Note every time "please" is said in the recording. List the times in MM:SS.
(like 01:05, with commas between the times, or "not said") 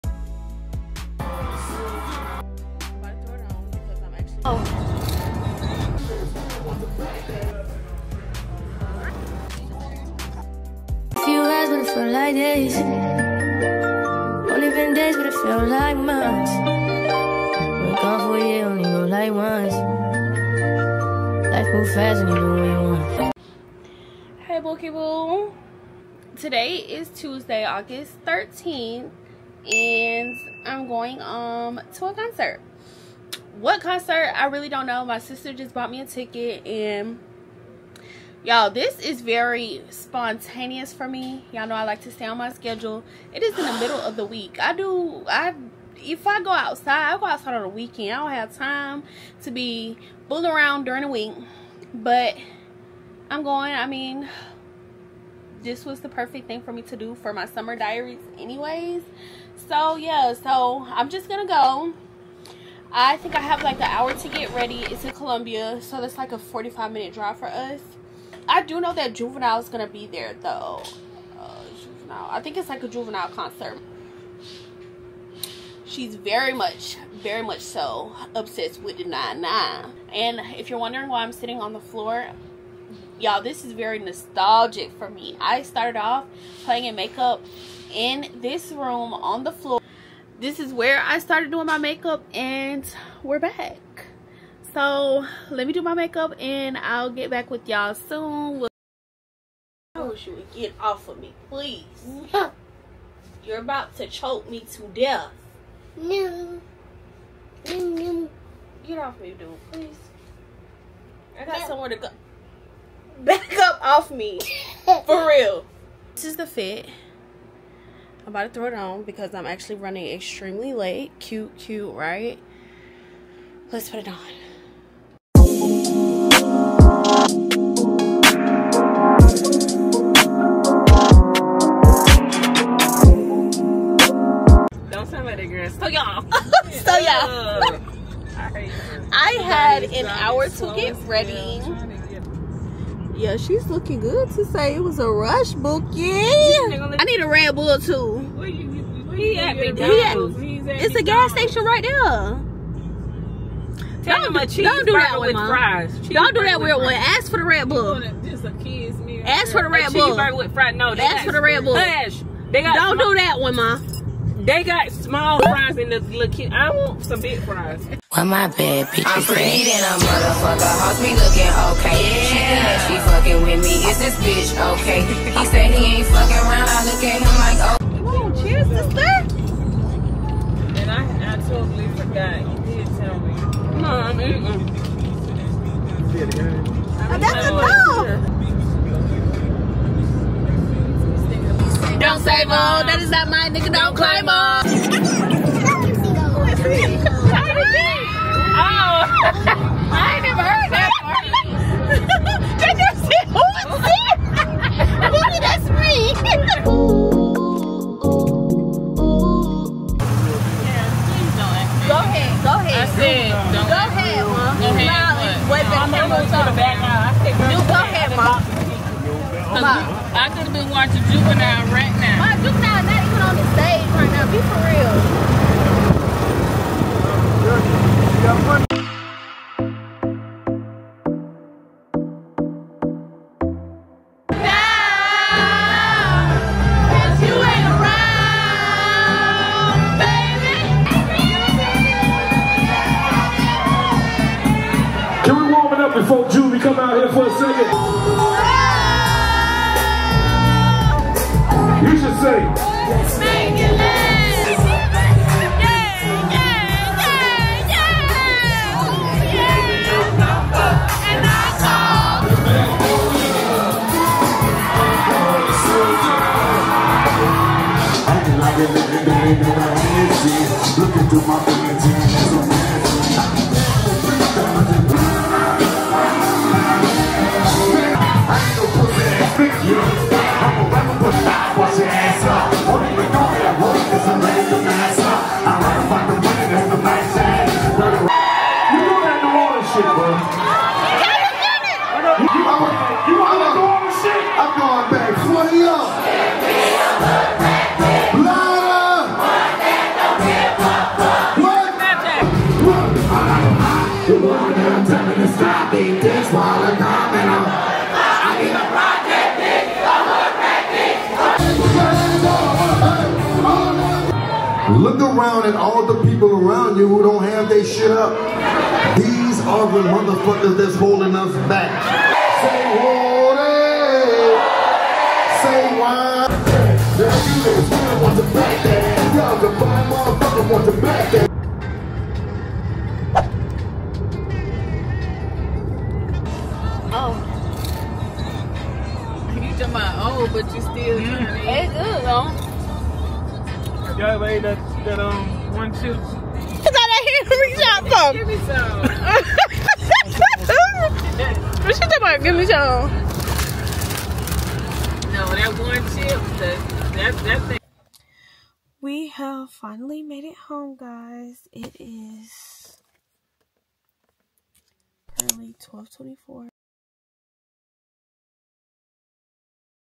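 01:41, 01:49.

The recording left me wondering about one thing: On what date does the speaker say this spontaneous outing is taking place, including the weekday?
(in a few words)
Tuesday, August 13th.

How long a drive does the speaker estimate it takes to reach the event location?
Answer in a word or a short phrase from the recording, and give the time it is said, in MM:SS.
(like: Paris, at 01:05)
45 minutes, at 01:06.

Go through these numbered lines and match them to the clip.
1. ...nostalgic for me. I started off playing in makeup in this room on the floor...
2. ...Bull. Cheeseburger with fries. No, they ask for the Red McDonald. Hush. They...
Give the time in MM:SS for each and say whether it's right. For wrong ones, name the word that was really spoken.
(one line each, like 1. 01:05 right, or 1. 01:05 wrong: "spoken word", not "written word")
1. 01:23 right
2. 02:39 wrong: "Bull", not "McDonald".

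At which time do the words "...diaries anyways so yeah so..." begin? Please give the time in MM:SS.
00:57.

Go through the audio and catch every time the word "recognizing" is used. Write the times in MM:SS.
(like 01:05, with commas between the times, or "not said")
not said.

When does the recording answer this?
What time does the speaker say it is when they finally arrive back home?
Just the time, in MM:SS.
06:05.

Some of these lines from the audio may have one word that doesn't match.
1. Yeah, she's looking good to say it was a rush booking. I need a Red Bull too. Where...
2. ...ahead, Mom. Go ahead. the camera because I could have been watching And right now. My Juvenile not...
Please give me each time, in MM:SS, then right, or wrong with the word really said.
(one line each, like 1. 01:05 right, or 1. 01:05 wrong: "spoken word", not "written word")
1. 02:23 right
2. 03:33 wrong: "Juvenile", not "And".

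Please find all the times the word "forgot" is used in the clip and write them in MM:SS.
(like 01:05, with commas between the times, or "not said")
03:01.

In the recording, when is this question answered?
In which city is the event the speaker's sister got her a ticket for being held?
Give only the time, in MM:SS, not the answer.
01:05.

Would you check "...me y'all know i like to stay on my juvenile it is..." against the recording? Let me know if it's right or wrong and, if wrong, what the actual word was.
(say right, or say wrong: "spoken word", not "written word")
wrong: "schedule", not "juvenile".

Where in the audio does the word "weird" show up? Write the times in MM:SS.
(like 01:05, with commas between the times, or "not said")
02:36.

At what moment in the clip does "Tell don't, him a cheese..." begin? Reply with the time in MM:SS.
02:32.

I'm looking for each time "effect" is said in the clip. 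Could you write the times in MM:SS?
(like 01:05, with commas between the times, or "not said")
not said.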